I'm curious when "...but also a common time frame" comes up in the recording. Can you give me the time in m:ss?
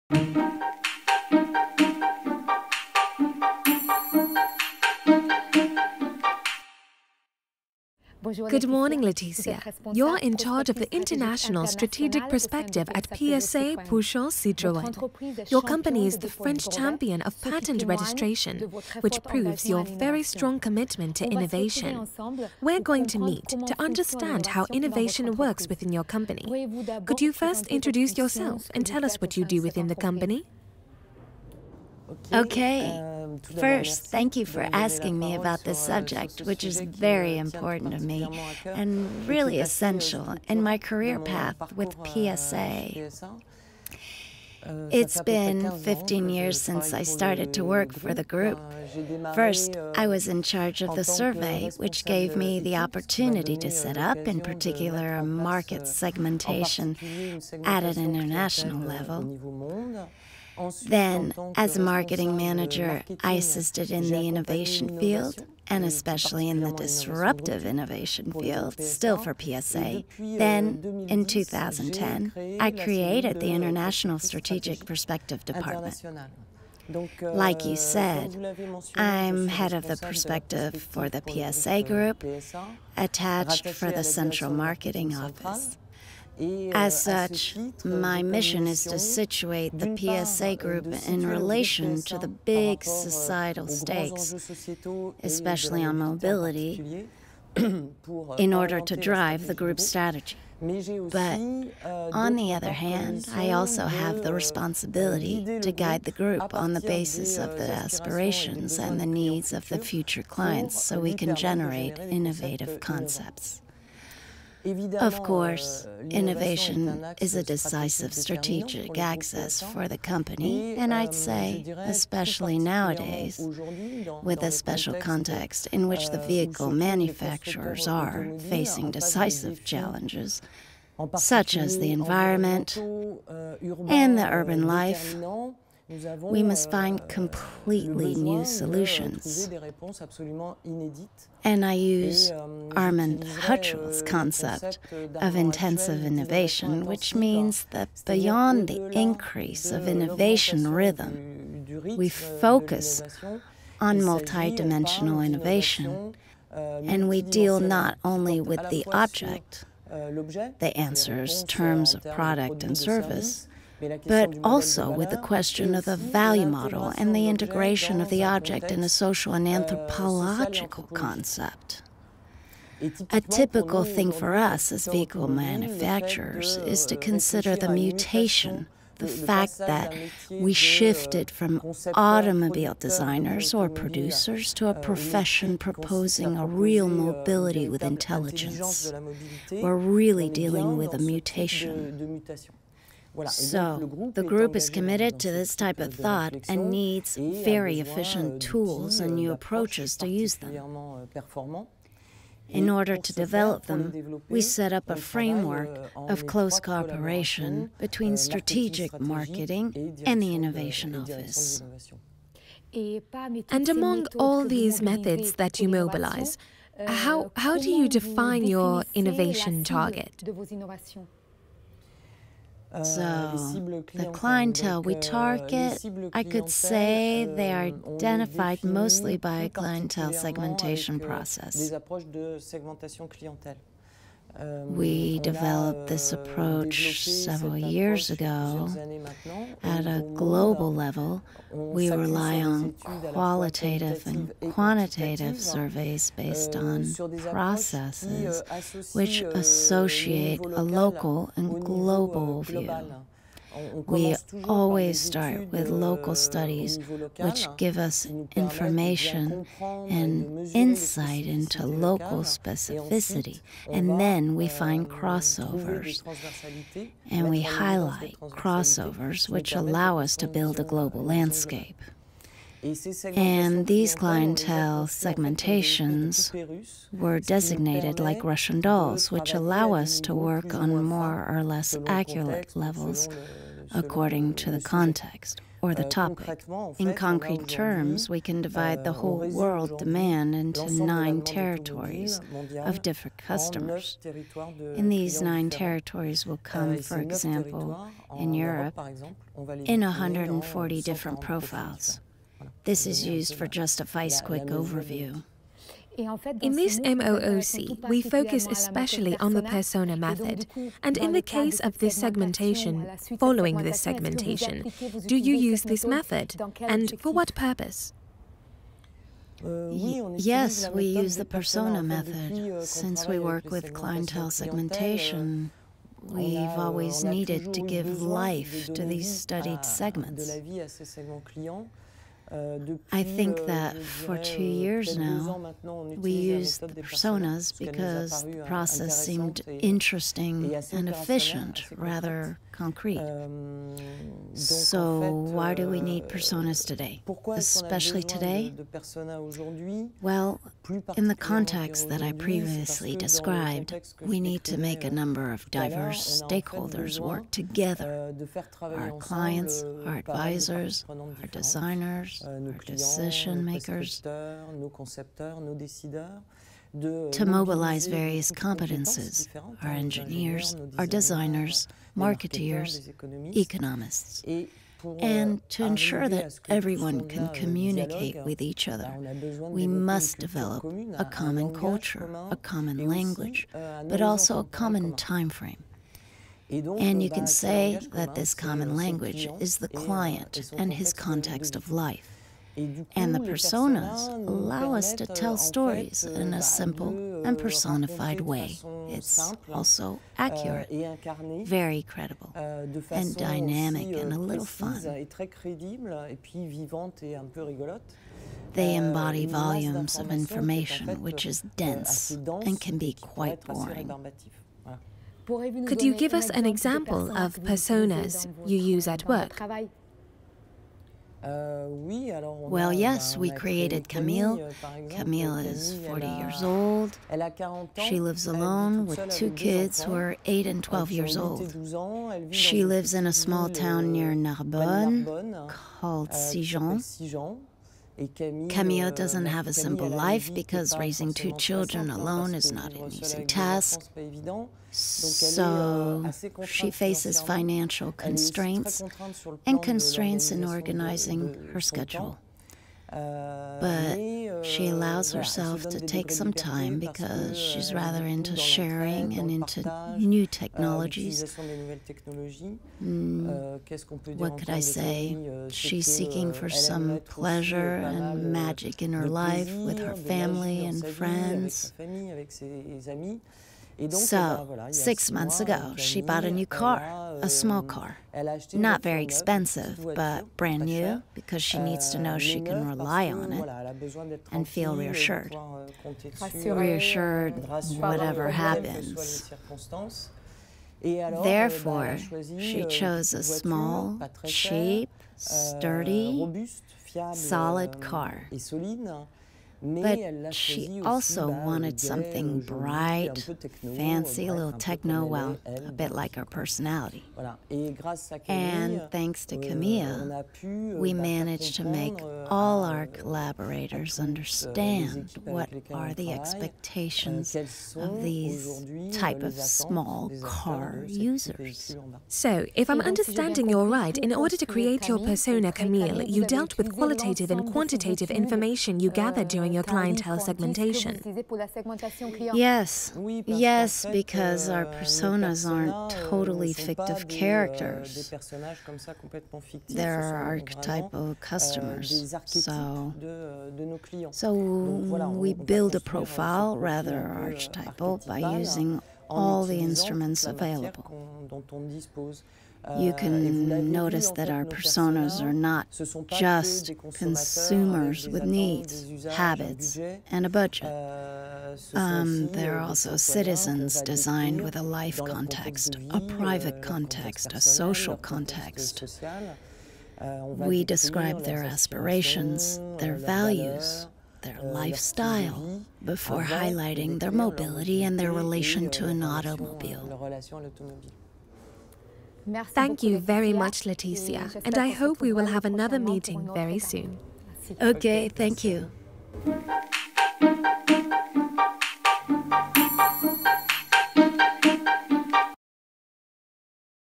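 6:23.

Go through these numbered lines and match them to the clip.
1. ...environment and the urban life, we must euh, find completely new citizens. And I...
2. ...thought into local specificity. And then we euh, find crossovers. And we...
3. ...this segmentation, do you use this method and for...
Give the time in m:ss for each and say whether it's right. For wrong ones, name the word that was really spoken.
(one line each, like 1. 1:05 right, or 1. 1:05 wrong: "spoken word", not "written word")
1. 2:11 wrong: "solutions", not "citizens"
2. 4:20 wrong: "insight", not "thought"
3. 5:13 right.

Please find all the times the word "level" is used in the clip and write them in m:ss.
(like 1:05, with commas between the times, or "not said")
0:58, 4:00, 4:42.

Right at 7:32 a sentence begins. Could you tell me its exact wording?
Uh, but uh, she allows herself to take some time because she's rather into sharing and into new uh, technologies.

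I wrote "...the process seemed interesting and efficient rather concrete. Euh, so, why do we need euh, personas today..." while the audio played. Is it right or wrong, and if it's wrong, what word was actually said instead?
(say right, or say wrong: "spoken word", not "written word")
right.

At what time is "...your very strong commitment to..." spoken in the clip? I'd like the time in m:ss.
0:19.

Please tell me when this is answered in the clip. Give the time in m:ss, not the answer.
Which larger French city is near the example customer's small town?
7:14.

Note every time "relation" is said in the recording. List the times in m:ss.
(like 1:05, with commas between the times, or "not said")
1:31, 9:38.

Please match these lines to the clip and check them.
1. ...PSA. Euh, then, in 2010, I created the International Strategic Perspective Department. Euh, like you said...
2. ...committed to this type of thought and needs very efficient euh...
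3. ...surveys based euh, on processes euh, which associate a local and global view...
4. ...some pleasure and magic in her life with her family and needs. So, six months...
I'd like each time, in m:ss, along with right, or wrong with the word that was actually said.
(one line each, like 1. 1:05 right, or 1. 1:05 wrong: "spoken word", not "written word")
1. 1:09 right
2. 3:14 right
3. 4:05 right
4. 7:46 wrong: "friends", not "needs".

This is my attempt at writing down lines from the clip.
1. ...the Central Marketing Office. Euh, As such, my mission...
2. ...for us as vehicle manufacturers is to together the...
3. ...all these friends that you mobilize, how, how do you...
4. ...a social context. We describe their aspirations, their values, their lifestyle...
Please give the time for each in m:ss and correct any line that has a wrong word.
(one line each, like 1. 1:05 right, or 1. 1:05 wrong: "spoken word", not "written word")
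1. 1:23 right
2. 2:54 wrong: "consider", not "together"
3. 3:34 wrong: "methods", not "friends"
4. 9:27 right.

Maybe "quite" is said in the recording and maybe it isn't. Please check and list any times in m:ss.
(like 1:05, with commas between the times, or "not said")
6:52.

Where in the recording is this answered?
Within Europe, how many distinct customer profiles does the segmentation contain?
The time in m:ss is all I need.
4:59.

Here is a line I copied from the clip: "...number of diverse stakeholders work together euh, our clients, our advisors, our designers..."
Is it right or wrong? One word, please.
right.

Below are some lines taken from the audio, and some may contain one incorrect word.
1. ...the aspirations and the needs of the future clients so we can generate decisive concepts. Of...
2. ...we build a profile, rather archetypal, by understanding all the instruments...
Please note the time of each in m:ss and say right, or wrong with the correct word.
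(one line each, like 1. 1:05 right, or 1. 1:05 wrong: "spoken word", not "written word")
1. 1:47 wrong: "innovative", not "decisive"
2. 9:05 wrong: "using", not "understanding".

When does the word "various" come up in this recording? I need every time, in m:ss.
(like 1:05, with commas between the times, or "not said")
6:07.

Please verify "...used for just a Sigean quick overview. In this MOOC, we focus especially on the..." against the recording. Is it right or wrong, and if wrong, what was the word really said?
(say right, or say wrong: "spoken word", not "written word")
wrong: "FICE", not "Sigean".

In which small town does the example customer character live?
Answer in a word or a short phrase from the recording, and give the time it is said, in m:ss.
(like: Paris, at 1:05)
Sigean, at 7:16.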